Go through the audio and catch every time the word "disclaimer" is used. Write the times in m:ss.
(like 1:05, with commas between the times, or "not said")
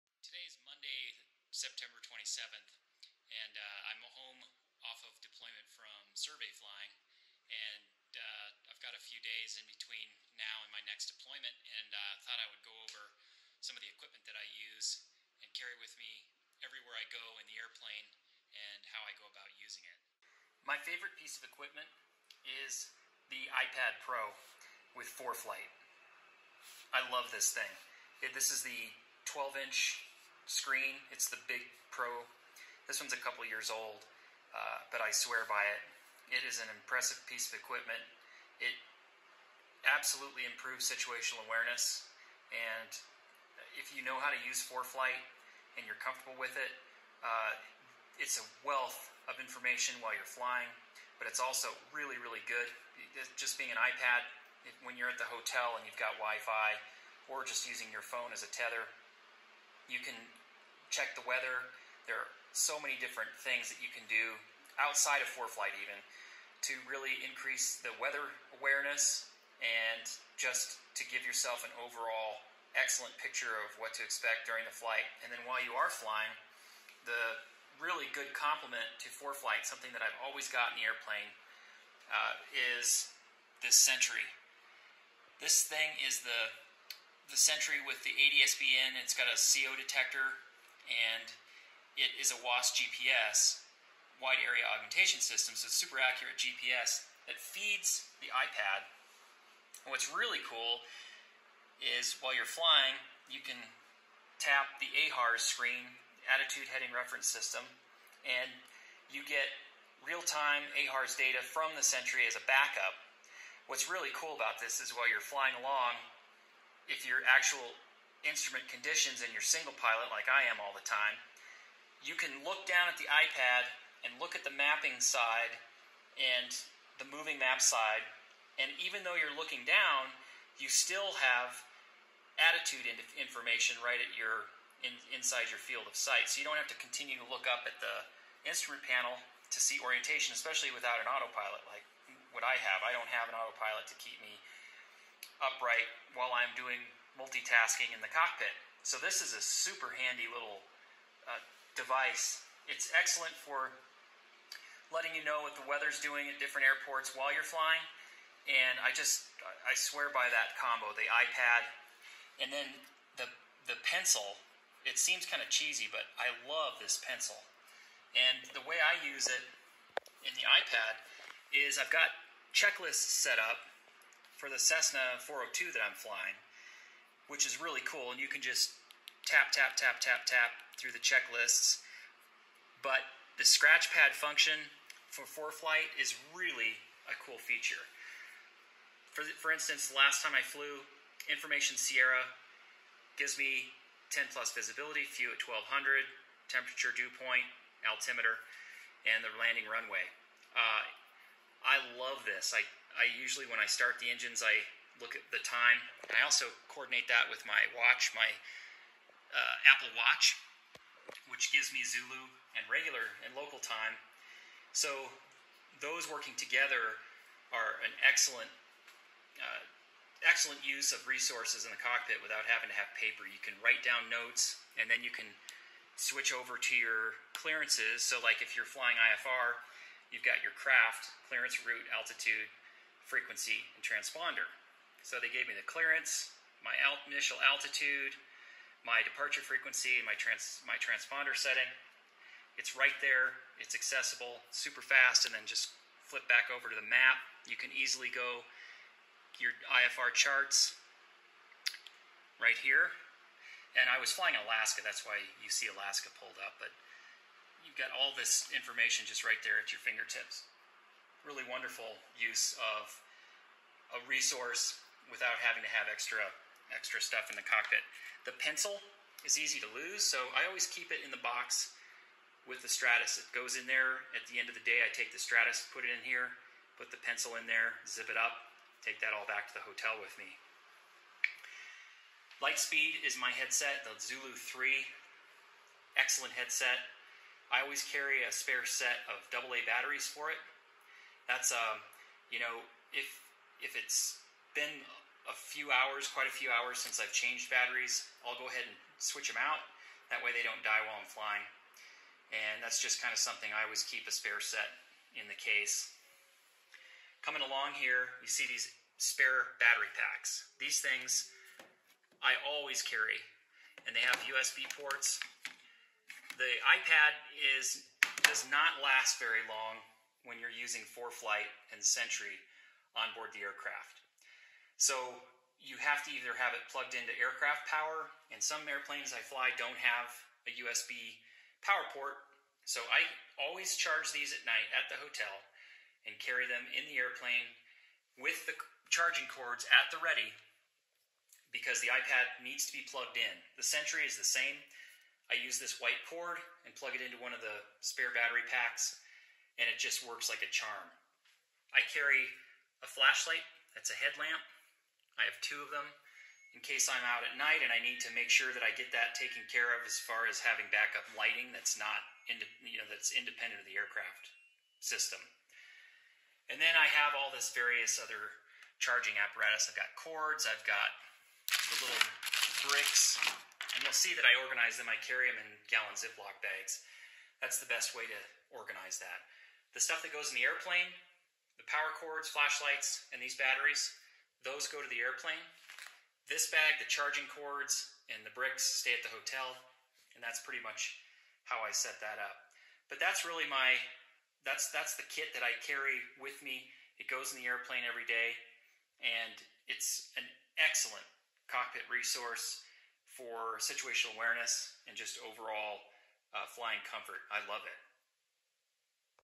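not said.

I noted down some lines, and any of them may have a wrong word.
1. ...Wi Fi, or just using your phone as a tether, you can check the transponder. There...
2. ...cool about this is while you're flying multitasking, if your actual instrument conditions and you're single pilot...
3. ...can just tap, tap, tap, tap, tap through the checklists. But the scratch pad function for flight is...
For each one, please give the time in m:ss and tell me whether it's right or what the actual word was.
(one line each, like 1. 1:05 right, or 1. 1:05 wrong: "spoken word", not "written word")
1. 0:56 wrong: "weather", not "transponder"
2. 1:54 wrong: "along", not "multitasking"
3. 2:58 right.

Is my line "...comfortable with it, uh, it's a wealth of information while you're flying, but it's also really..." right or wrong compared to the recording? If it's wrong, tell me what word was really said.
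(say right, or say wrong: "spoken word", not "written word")
right.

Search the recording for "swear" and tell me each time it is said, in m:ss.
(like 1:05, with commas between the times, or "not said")
0:35, 2:39.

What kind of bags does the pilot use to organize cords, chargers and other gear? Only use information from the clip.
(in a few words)
gallon Ziploc bags.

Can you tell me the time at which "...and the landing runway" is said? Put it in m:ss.
3:19.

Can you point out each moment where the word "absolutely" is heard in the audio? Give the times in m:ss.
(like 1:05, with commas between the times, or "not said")
0:39.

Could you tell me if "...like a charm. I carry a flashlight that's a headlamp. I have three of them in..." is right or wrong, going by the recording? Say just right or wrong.
wrong.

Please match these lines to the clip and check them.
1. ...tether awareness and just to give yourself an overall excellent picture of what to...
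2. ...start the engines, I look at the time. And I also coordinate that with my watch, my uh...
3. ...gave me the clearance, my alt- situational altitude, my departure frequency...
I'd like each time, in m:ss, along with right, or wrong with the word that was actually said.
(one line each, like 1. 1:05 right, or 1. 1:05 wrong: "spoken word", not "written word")
1. 1:07 wrong: "weather", not "tether"
2. 3:23 right
3. 3:55 wrong: "initial", not "situational".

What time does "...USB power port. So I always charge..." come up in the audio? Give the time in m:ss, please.
5:30.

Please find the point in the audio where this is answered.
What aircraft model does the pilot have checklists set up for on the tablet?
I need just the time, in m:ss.
2:54.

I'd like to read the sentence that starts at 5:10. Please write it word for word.
These things I always carry, and they have USB ports.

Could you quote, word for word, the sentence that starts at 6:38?
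And it's an excellent cockpit resource for situational awareness and just overall uh, flying comfort.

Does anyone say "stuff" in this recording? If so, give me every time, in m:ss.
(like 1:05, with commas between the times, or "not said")
4:27, 6:19.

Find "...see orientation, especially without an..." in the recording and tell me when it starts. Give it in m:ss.
2:19.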